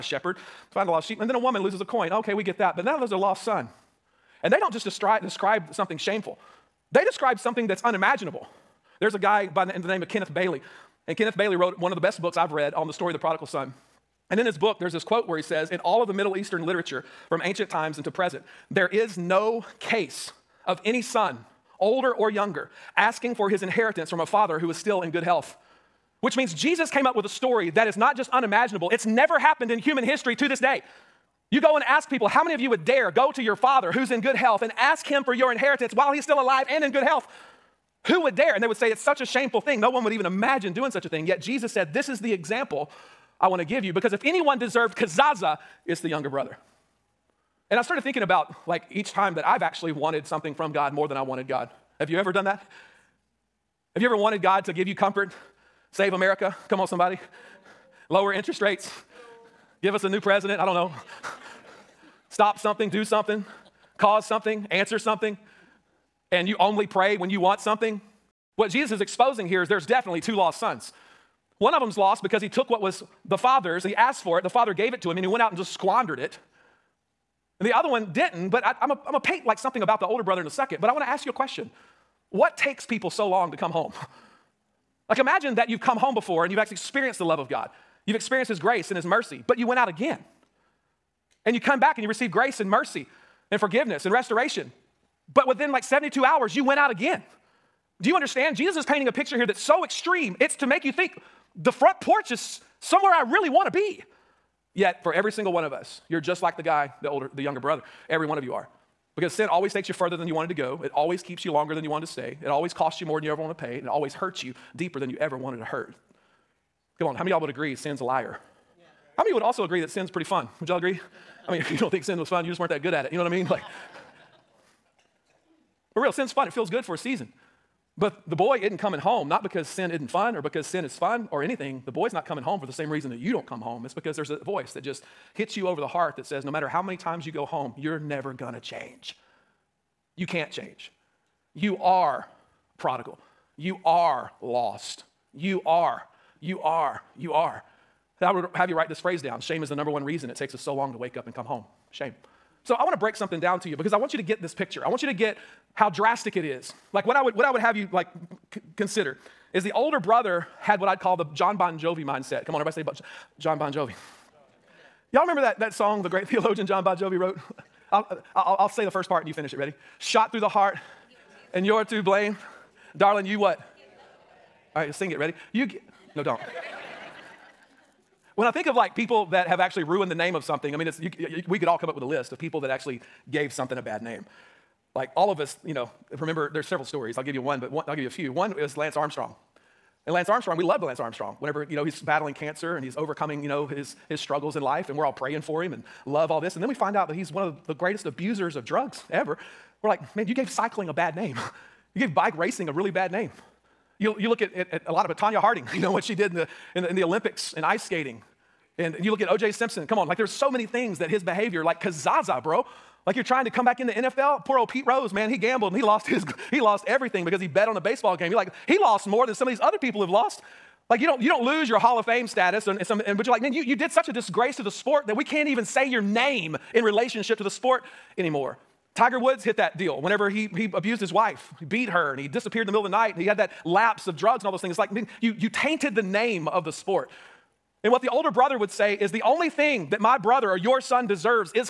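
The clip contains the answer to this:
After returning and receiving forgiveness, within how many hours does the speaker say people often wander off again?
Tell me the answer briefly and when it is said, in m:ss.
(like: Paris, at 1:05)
72 hours, at 1:35.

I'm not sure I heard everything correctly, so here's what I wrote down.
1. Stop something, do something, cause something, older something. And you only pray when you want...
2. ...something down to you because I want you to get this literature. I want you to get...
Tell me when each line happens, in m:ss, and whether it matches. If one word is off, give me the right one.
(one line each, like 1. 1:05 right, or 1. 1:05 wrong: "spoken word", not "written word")
1. 1:02 wrong: "answer", not "older"
2. 2:33 wrong: "picture", not "literature".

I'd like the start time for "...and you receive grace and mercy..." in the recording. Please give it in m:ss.
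1:31.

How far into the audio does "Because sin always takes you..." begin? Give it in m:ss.
1:49.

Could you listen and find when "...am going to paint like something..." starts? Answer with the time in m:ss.
1:18.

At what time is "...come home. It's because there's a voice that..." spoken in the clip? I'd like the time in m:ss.
2:13.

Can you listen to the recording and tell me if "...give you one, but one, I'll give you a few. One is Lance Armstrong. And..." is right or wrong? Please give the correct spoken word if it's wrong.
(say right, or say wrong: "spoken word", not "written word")
right.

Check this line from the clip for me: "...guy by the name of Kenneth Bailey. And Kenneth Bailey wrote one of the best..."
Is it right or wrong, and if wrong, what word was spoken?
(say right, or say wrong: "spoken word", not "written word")
right.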